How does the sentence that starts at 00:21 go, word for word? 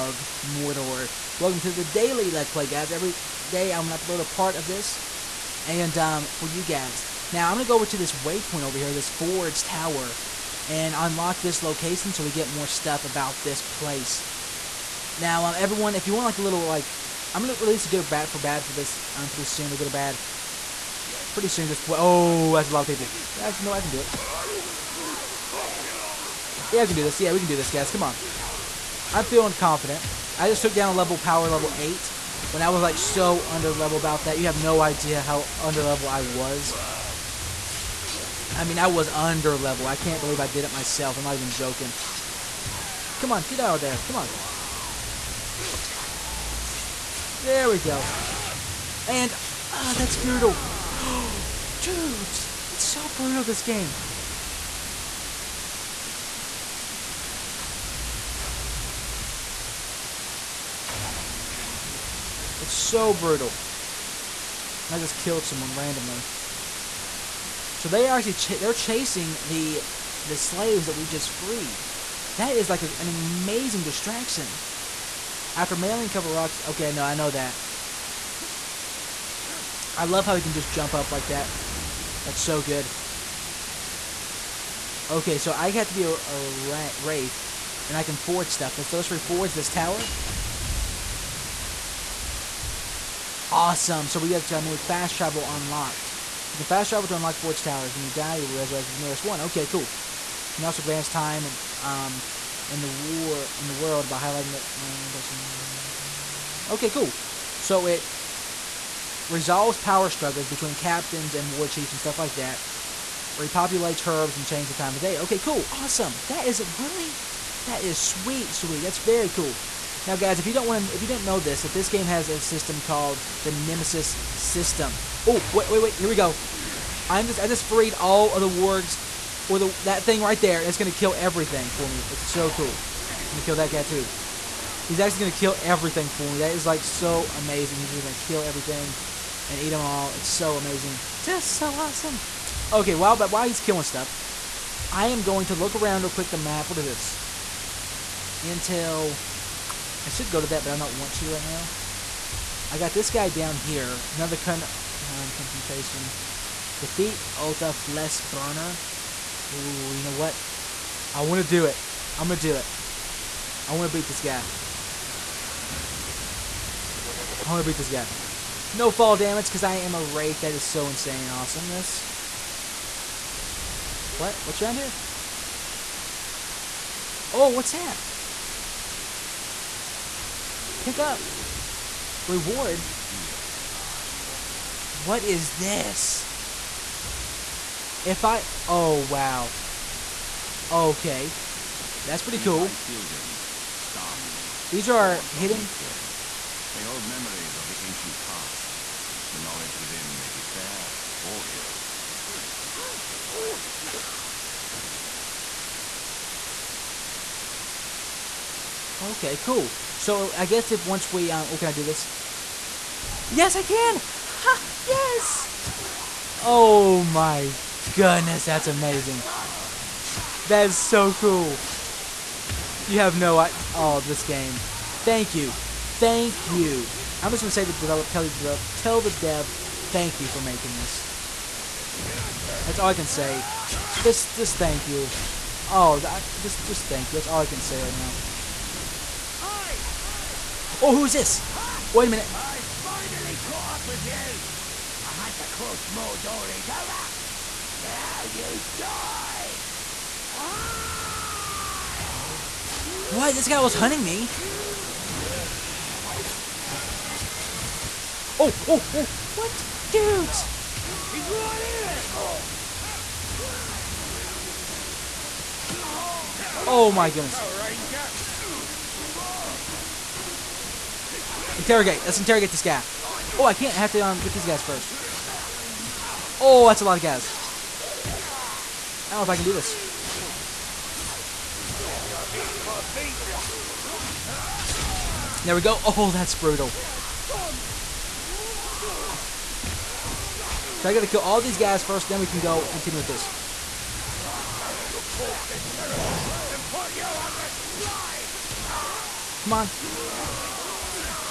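Pretty soon, just, oh, that's a lot of people.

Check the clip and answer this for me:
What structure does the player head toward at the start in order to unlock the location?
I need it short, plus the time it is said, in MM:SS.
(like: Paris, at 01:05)
Forge Tower, at 00:09.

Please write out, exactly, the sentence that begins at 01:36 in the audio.
You can fast travel to unlock forge towers.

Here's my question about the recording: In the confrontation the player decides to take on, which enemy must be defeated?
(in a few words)
Otha Flesh Burner.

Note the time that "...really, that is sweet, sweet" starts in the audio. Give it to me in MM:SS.
01:56.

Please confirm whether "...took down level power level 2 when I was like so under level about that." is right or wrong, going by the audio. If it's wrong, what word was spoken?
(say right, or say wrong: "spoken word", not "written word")
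wrong: "8", not "2".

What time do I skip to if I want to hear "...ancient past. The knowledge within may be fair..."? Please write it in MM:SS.
03:17.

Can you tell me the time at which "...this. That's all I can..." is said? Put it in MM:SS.
03:50.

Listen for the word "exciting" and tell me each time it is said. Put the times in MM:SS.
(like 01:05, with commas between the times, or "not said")
not said.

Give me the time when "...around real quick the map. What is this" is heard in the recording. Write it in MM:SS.
02:25.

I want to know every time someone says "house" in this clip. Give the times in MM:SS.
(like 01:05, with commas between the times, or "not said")
not said.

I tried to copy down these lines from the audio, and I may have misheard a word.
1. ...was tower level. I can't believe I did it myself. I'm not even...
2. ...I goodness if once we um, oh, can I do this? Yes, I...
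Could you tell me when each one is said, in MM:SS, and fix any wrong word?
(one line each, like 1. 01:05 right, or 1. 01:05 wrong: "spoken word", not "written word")
1. 00:38 wrong: "under", not "tower"
2. 03:30 wrong: "guess", not "goodness".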